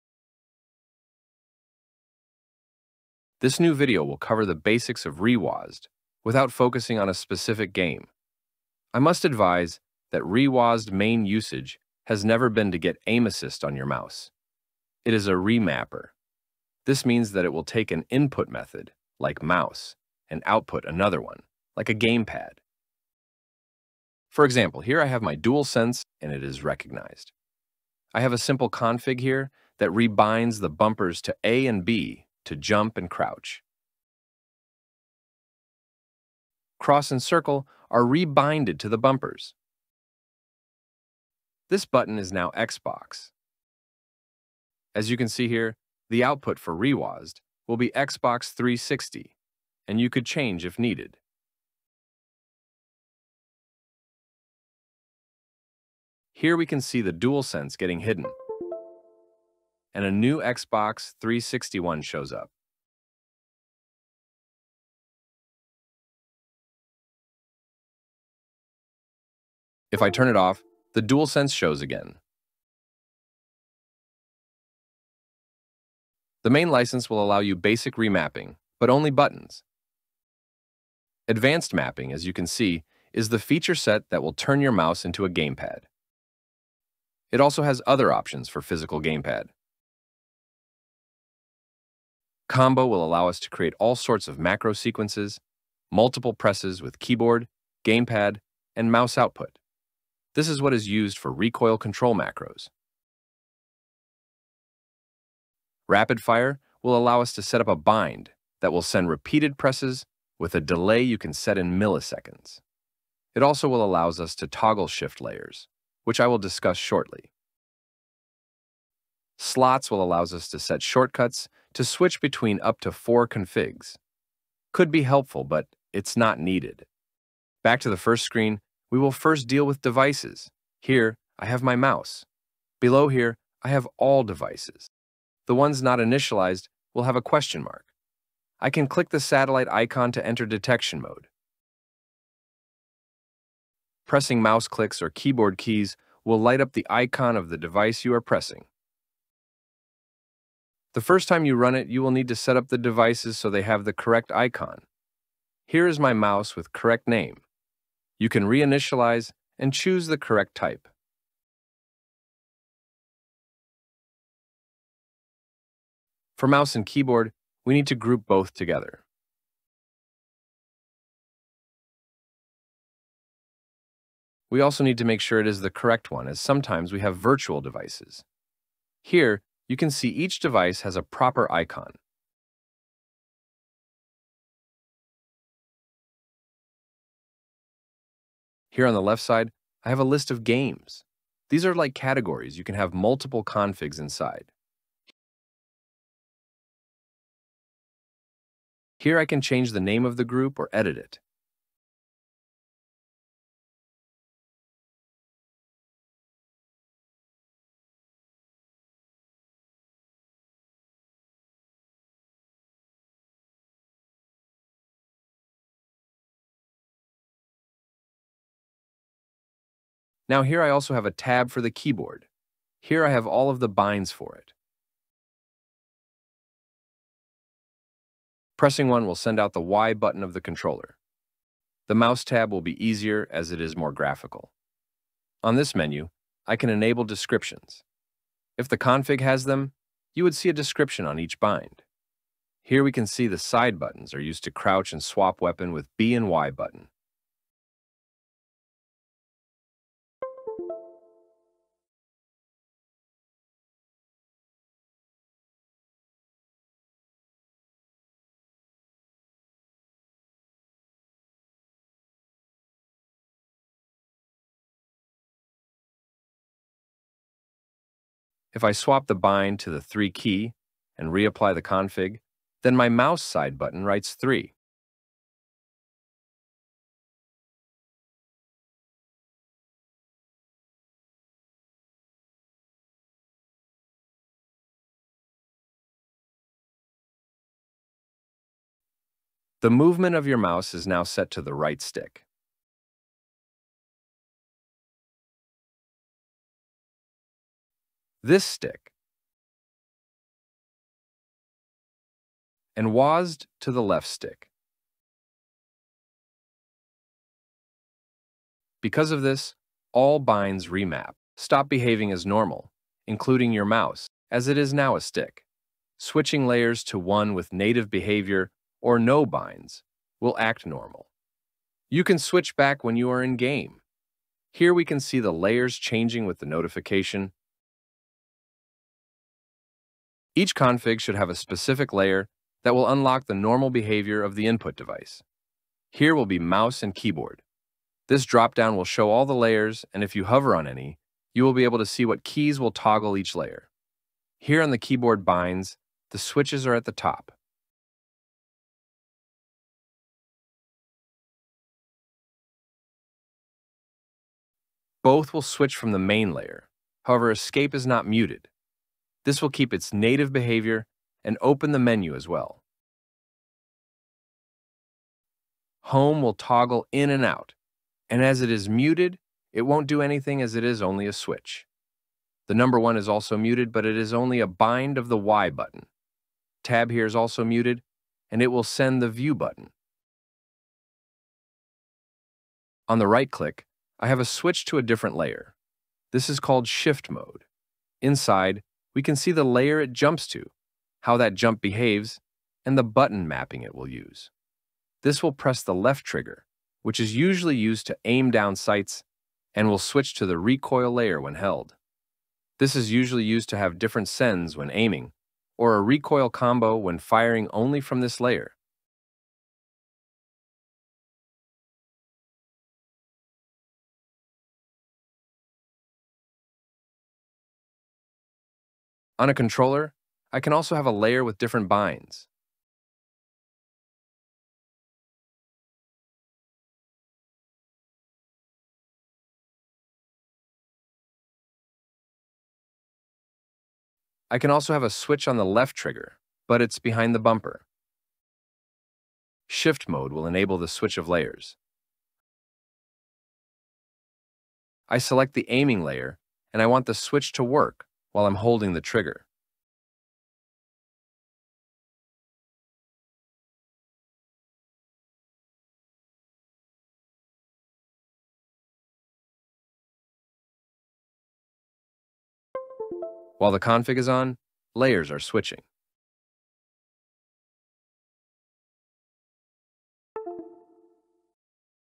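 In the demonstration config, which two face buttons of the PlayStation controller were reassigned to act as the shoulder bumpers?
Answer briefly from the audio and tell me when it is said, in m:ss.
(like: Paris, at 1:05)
Cross and circle, at 0:36.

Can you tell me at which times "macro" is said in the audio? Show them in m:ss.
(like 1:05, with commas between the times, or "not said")
1:34, 1:42.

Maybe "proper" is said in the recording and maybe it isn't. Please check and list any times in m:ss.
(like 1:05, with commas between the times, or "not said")
3:01.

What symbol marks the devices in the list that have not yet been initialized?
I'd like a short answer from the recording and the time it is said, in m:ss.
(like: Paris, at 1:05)
Question mark, at 2:17.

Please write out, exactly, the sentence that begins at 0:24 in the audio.
For example, here I have my DualSense and it is recognized.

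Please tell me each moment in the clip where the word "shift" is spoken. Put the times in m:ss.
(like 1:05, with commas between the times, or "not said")
1:54, 6:26, 7:19.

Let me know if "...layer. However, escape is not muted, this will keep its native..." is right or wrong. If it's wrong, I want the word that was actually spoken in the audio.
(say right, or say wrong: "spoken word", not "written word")
right.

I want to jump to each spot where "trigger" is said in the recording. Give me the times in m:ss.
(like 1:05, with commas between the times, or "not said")
6:36, 7:15, 7:28.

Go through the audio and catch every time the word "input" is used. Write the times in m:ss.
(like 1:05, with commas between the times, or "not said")
0:18, 5:34.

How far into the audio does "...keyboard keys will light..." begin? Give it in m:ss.
2:25.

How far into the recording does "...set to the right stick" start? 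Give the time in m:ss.
4:51.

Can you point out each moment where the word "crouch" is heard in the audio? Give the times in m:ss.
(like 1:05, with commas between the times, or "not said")
0:33, 4:04.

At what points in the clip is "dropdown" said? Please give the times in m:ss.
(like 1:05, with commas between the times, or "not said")
5:38.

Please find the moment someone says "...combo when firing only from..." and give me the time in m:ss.
6:46.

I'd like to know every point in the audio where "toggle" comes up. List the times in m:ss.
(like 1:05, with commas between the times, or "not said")
1:54, 5:42, 6:06.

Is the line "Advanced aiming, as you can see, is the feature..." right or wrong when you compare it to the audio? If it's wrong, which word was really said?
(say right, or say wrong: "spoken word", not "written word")
wrong: "mapping", not "aiming".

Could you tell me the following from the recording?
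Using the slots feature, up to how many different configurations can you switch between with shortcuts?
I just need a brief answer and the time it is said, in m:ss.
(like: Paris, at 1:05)
Four, at 2:02.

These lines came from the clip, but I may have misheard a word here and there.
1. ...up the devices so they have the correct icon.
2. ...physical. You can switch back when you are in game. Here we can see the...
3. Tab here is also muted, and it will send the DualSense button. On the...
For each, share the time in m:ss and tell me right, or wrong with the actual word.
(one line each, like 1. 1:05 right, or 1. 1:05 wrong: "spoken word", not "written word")
1. 2:32 right
2. 5:20 wrong: "normal", not "physical"
3. 6:16 wrong: "View", not "DualSense".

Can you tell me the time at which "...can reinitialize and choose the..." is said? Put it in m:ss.
2:38.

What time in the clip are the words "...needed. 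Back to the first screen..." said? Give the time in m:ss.
2:06.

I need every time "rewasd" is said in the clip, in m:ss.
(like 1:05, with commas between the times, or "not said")
0:05, 0:10, 0:46.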